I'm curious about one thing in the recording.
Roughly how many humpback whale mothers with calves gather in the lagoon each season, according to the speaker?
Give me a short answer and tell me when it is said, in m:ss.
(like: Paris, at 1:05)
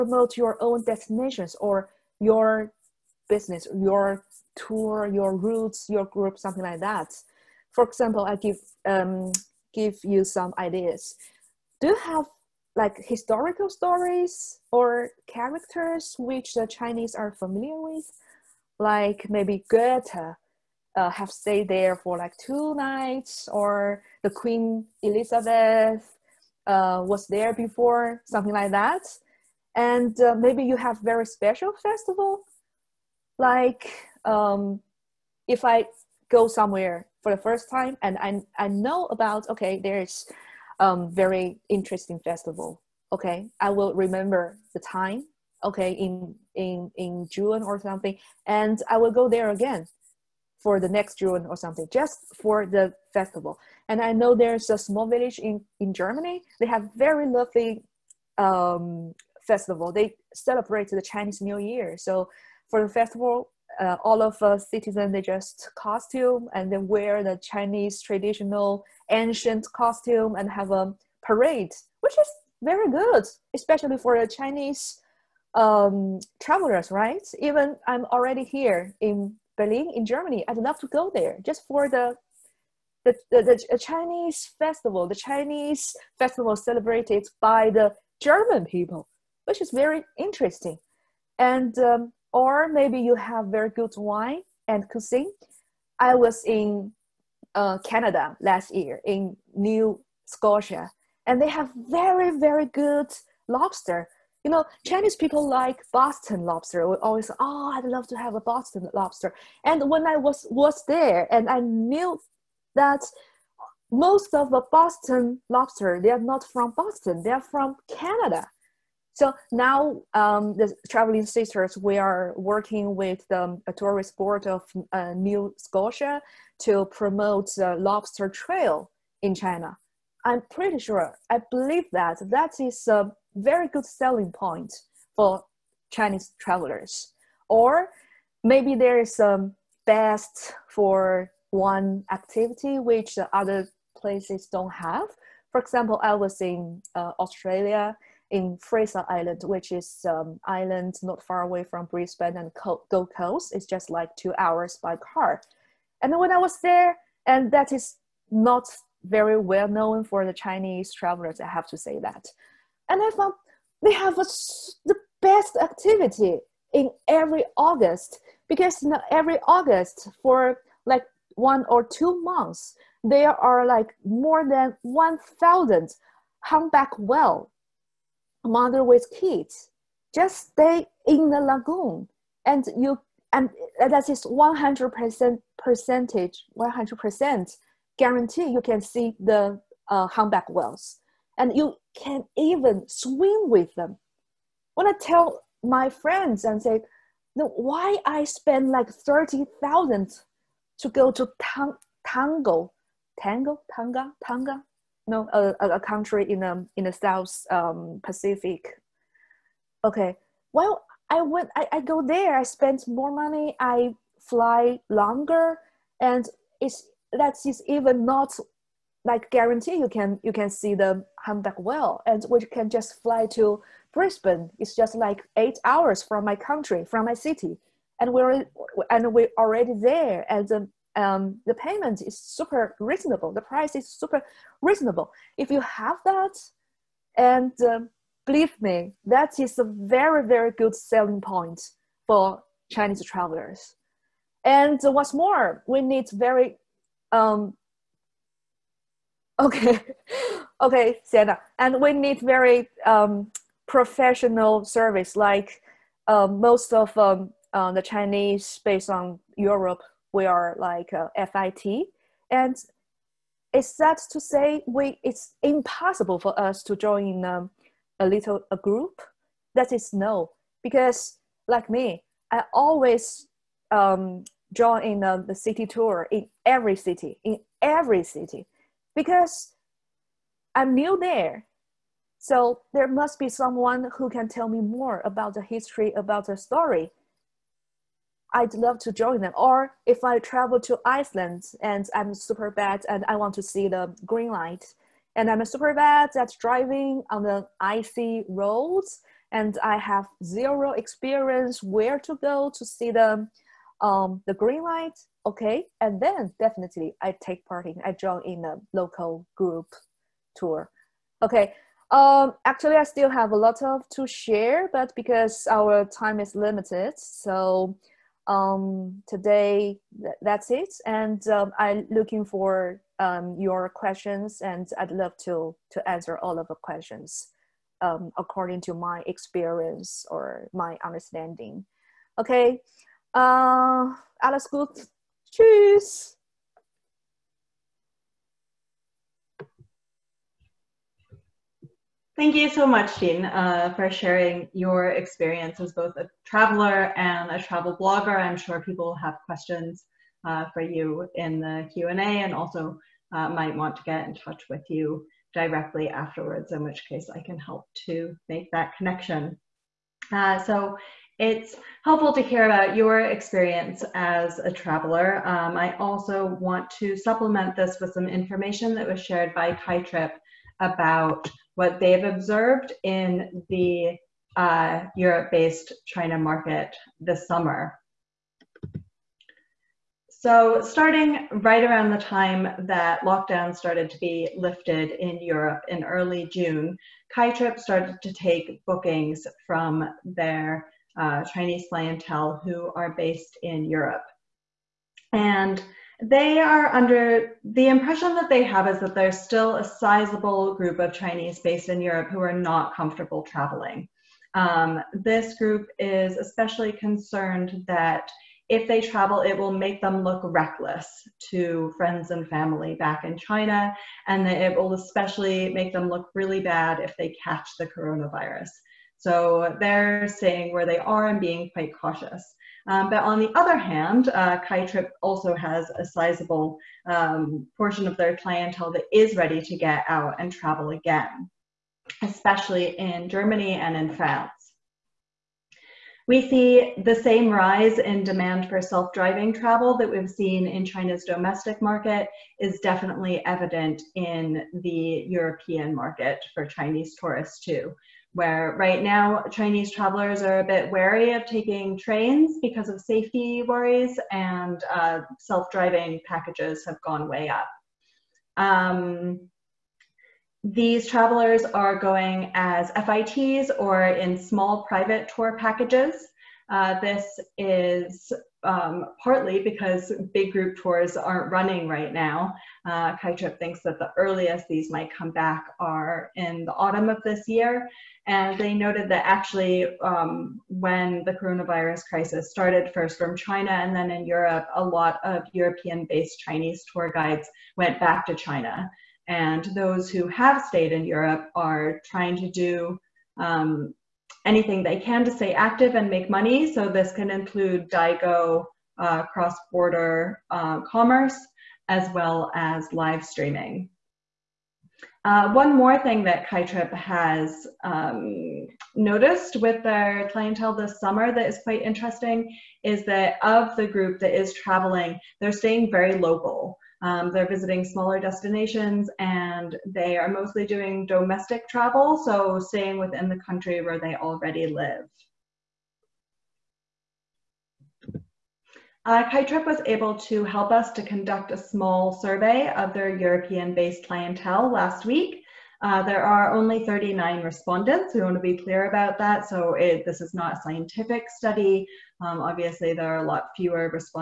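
more than 1,000, at 2:54.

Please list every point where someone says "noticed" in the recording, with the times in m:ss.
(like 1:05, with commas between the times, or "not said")
8:28.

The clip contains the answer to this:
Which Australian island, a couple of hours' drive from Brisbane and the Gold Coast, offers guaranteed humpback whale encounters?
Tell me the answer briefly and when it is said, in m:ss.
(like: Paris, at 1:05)
Fraser Island, at 2:28.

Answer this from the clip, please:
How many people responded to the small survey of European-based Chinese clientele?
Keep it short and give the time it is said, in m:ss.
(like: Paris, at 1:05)
39, at 8:56.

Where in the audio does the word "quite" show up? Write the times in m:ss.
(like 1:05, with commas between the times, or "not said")
7:01, 8:31.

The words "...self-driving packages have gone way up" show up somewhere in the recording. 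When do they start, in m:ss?
7:35.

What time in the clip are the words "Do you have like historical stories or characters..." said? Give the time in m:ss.
0:11.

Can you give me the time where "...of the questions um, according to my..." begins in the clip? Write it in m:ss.
5:26.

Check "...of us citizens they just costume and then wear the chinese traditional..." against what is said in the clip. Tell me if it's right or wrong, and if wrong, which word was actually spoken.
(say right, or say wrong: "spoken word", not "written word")
right.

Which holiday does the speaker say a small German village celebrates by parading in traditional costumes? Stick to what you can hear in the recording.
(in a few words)
Chinese New Year.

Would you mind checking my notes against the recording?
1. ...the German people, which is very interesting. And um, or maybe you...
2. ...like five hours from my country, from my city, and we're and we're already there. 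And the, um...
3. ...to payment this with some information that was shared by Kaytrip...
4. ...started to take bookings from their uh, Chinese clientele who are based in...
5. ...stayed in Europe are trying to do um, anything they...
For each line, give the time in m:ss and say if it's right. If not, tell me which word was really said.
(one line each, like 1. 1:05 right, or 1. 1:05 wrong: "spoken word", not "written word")
1. 1:27 right
2. 3:44 wrong: "eight", not "five"
3. 6:06 wrong: "supplement", not "payment"
4. 6:27 right
5. 8:10 right.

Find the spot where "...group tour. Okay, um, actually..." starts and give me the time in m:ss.
5:09.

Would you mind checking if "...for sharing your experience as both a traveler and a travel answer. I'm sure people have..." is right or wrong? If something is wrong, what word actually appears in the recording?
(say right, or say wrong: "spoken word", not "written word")
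wrong: "blogger", not "answer".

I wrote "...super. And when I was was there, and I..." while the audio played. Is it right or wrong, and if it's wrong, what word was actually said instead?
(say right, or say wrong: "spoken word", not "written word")
wrong: "lobster", not "super".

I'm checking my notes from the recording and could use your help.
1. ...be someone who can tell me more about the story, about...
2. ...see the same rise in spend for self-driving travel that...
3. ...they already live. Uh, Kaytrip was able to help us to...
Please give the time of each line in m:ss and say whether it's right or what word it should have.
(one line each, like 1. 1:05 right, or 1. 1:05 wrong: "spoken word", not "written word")
1. 4:43 wrong: "history", not "story"
2. 7:16 wrong: "demand", not "spend"
3. 8:43 right.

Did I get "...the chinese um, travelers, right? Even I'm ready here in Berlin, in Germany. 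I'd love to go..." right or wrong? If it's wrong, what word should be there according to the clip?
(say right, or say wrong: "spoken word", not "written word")
wrong: "already", not "ready".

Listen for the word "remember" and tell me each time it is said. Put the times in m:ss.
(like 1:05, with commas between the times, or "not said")
0:43.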